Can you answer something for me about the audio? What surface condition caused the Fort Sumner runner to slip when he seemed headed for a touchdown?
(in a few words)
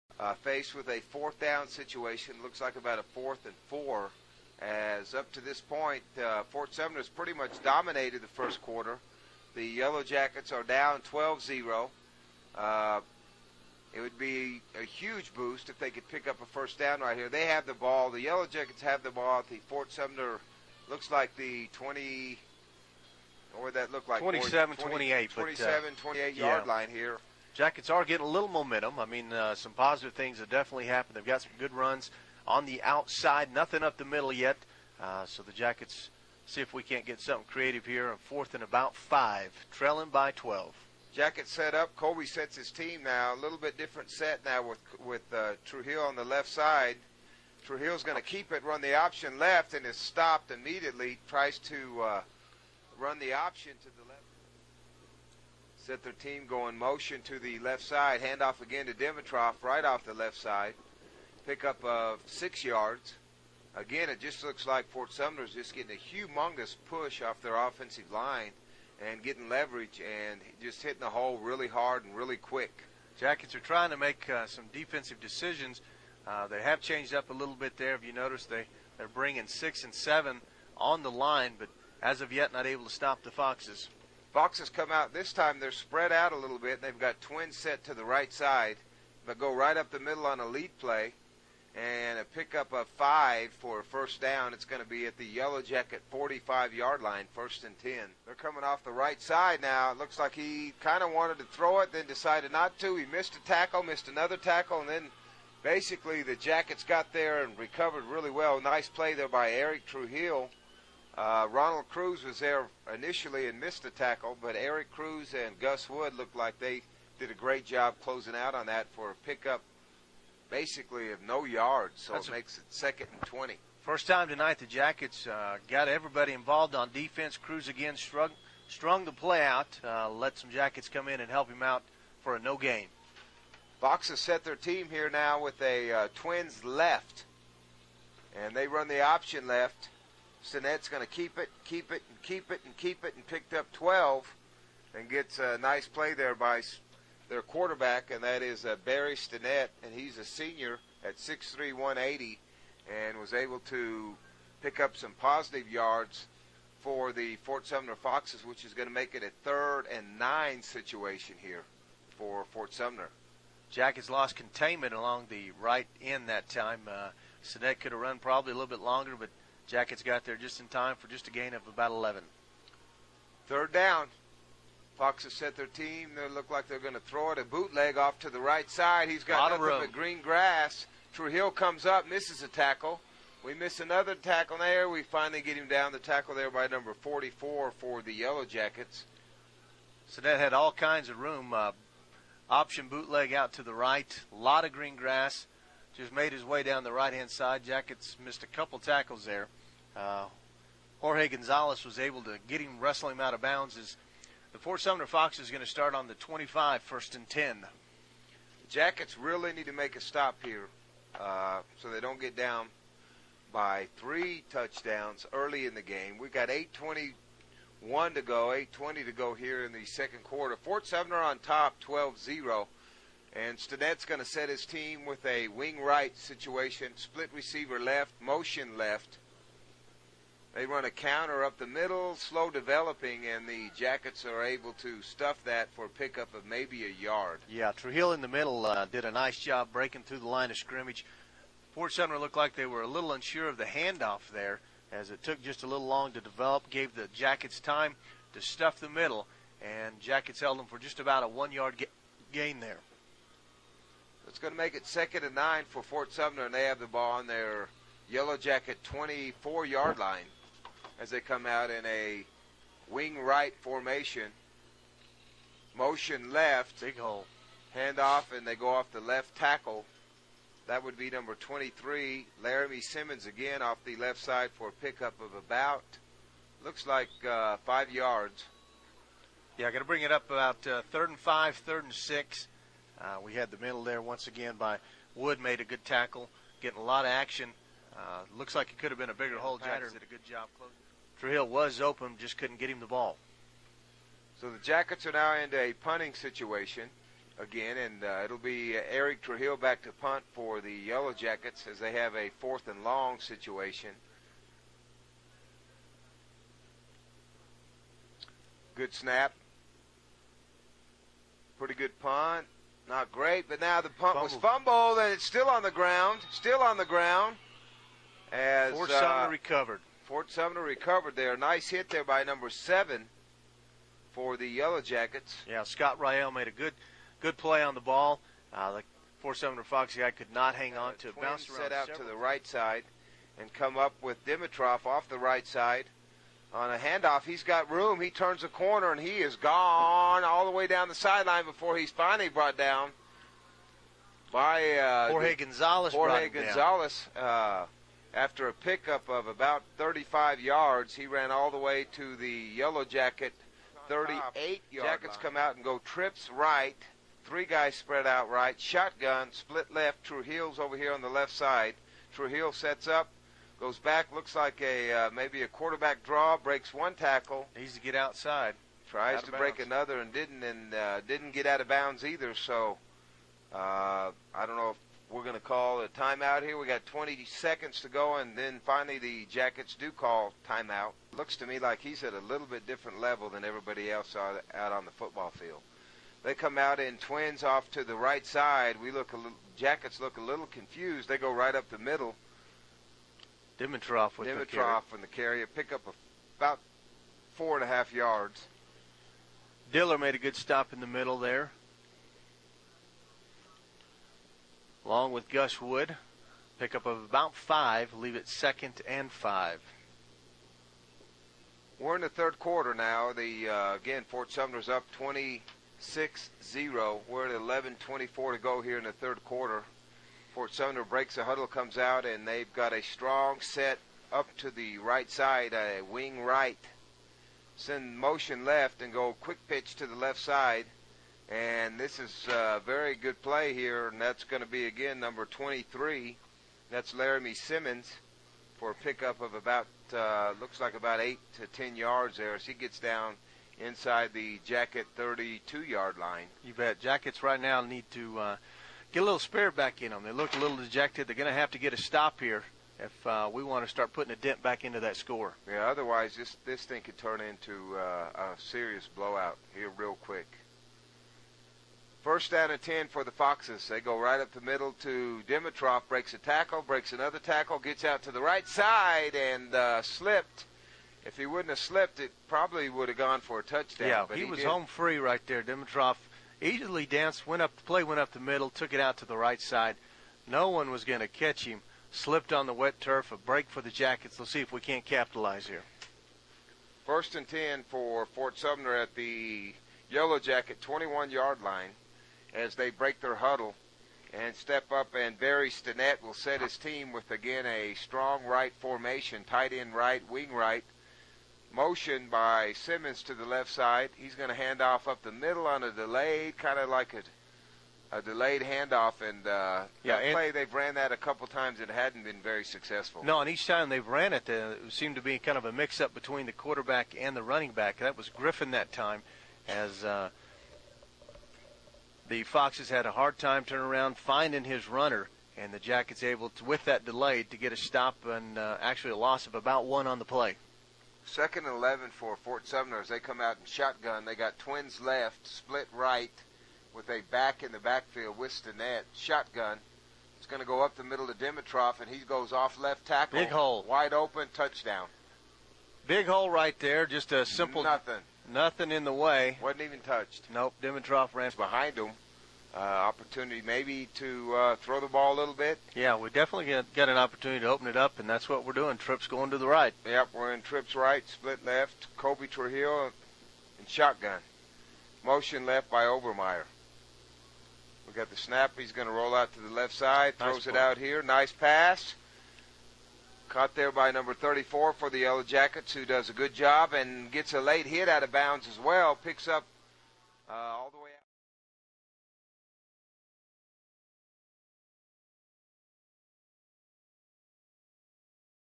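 wet turf.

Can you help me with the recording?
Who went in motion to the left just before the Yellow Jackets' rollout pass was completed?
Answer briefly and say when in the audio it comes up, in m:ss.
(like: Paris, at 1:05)
Obermeyer, at 9:25.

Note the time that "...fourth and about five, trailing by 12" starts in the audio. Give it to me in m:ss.
0:38.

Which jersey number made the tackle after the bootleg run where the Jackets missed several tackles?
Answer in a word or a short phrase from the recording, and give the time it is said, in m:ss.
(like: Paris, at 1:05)
44, at 3:06.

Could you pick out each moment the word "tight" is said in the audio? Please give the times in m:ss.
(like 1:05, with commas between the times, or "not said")
8:19.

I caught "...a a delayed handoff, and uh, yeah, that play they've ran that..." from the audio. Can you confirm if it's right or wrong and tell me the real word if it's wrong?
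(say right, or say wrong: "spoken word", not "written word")
right.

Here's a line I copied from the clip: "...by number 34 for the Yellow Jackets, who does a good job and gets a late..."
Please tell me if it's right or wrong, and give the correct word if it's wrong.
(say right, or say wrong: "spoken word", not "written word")
right.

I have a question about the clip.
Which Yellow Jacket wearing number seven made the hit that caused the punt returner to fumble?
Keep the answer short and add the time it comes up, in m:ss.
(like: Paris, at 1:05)
Scott Rael, at 5:25.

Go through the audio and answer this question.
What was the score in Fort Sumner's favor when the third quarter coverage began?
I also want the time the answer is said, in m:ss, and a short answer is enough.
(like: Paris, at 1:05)
26-0, at 6:54.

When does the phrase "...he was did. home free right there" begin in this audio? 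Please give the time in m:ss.
7:54.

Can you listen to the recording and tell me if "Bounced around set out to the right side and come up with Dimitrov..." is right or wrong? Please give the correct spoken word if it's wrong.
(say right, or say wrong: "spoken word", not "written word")
right.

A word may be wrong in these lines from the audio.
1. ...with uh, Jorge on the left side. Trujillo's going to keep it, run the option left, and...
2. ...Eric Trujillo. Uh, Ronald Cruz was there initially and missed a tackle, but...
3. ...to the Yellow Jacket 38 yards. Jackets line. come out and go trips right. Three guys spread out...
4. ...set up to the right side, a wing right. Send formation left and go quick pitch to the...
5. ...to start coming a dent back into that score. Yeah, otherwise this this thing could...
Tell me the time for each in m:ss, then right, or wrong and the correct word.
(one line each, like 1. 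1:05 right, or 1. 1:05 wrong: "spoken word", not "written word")
1. 0:45 wrong: "Trujillo", not "Jorge"
2. 1:49 right
3. 5:51 right
4. 7:03 wrong: "motion", not "formation"
5. 7:33 wrong: "putting", not "coming".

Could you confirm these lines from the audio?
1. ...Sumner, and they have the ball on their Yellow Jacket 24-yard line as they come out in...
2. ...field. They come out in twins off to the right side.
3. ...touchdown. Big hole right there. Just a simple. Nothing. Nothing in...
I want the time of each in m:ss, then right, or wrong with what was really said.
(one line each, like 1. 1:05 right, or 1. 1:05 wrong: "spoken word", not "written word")
1. 4:16 right
2. 6:25 right
3. 9:04 right.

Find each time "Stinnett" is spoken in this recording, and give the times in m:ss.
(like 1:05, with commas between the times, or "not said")
2:20, 2:29, 2:47, 3:43, 8:15, 8:58.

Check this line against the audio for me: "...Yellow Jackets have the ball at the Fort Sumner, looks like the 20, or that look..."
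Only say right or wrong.
right.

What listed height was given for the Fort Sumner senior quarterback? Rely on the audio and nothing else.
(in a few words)
6'3".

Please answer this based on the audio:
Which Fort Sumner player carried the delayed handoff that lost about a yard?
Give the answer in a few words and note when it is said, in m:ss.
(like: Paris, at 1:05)
Griffin, at 8:38.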